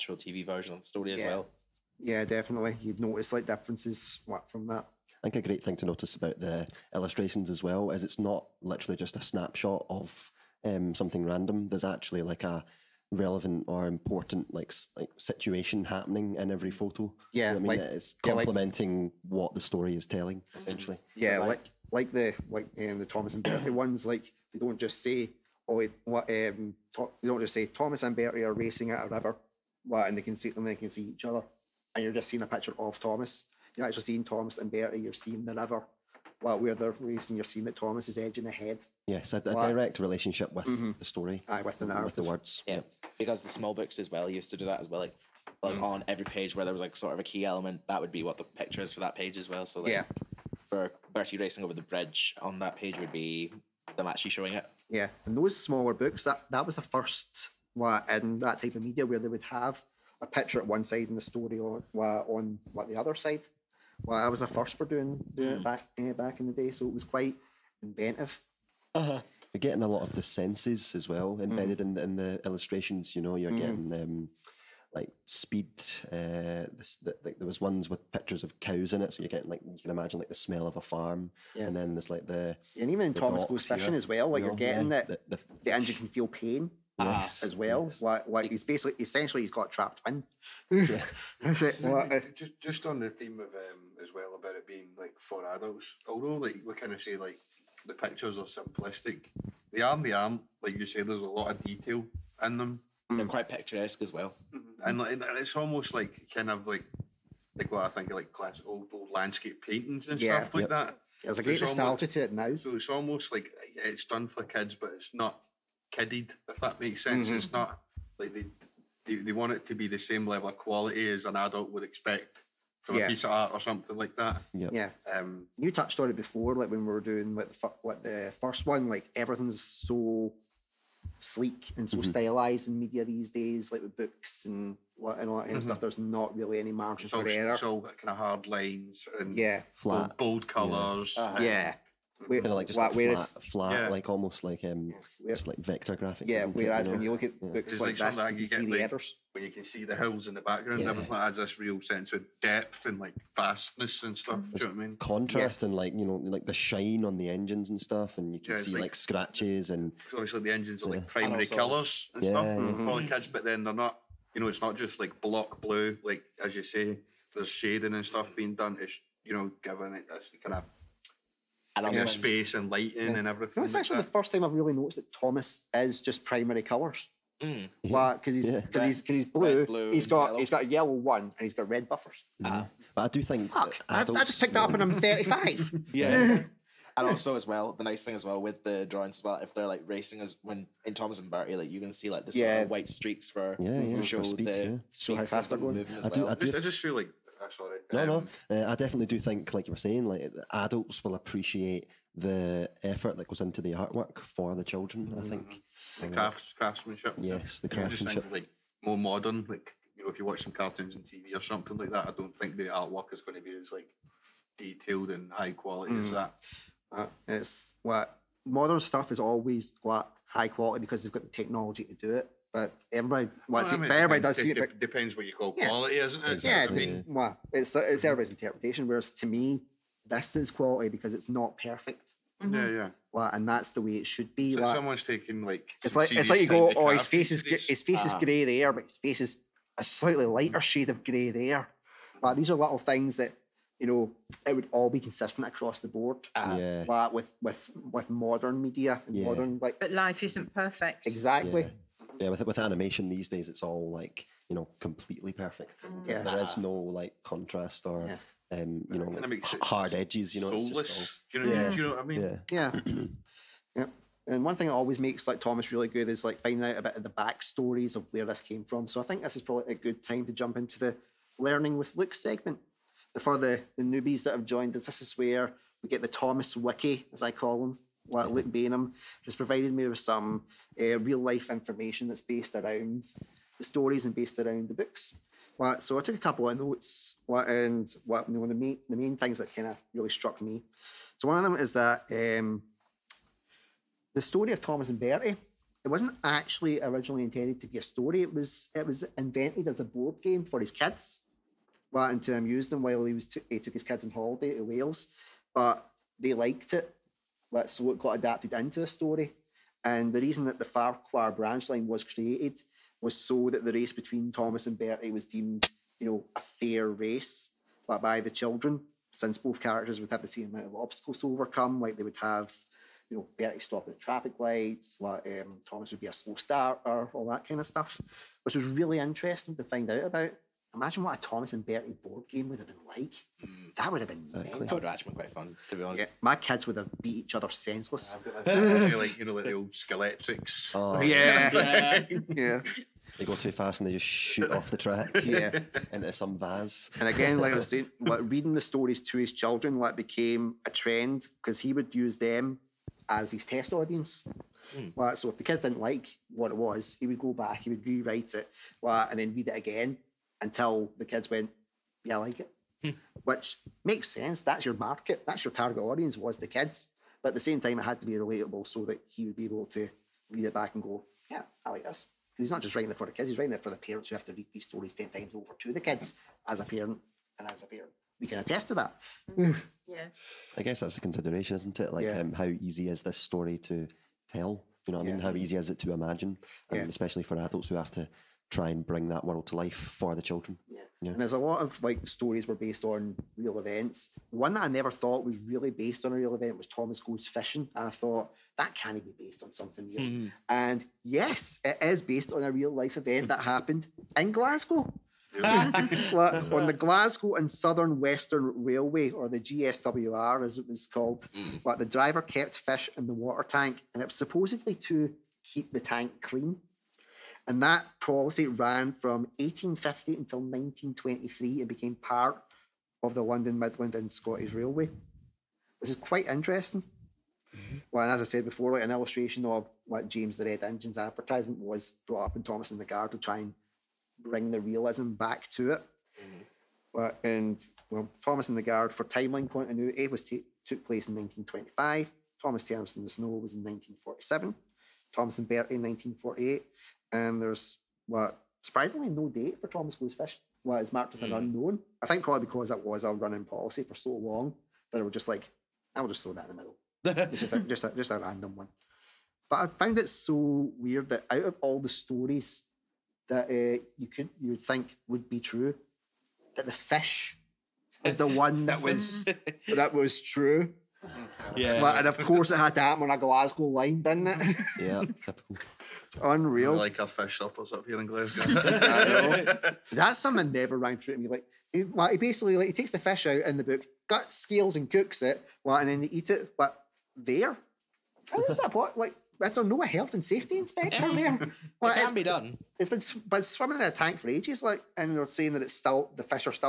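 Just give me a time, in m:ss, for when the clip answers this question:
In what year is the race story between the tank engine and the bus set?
7:25.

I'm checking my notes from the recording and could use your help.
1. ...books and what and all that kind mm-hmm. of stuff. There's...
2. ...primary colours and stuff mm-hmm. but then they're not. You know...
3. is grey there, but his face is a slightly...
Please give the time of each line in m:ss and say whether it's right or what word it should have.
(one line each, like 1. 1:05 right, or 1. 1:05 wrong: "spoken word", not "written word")
1. 2:13 right
2. 2:41 right
3. 3:58 right.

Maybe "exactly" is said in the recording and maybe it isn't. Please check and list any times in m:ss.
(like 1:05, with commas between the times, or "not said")
4:11, 5:34.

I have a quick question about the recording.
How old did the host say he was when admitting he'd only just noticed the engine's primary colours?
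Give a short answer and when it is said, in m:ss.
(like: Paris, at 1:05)
35, at 3:04.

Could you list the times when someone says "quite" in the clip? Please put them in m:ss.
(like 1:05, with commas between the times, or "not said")
1:07, 1:43, 5:35, 7:05.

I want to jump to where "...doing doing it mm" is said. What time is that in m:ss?
1:04.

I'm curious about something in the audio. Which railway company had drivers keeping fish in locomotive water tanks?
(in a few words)
Glasgow and Southern Western Railway.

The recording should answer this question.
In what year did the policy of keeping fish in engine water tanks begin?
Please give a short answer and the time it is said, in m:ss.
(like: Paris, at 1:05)
1850, at 6:59.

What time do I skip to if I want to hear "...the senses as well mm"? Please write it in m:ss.
1:10.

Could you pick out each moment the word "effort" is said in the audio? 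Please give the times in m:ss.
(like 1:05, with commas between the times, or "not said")
3:22.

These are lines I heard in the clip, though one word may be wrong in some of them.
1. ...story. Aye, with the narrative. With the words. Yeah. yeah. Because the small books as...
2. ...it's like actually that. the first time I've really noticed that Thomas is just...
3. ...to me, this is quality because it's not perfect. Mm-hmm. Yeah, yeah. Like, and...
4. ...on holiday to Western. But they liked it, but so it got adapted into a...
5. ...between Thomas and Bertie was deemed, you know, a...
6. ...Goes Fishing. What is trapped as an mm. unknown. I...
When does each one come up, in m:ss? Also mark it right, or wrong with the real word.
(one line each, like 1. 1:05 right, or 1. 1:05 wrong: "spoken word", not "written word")
1. 0:41 right
2. 2:53 right
3. 3:49 right
4. 5:04 wrong: "Wales", not "Western"
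5. 5:13 right
6. 7:29 wrong: "marked", not "trapped".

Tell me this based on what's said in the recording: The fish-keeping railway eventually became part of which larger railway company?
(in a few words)
London Midland and Scottish Railway.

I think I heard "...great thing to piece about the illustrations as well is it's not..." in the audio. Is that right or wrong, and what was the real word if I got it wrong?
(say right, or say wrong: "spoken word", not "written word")
wrong: "notice", not "piece".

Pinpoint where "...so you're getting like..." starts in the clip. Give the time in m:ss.
1:19.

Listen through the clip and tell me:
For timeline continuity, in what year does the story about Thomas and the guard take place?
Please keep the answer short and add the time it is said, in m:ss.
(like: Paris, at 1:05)
1925, at 7:21.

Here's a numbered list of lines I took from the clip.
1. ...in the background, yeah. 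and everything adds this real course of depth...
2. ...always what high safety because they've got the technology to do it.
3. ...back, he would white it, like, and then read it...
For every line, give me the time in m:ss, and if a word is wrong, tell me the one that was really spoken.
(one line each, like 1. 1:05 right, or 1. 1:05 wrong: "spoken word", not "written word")
1. 2:30 wrong: "sense", not "course"
2. 3:39 wrong: "quality", not "safety"
3. 5:57 wrong: "rewrite", not "white".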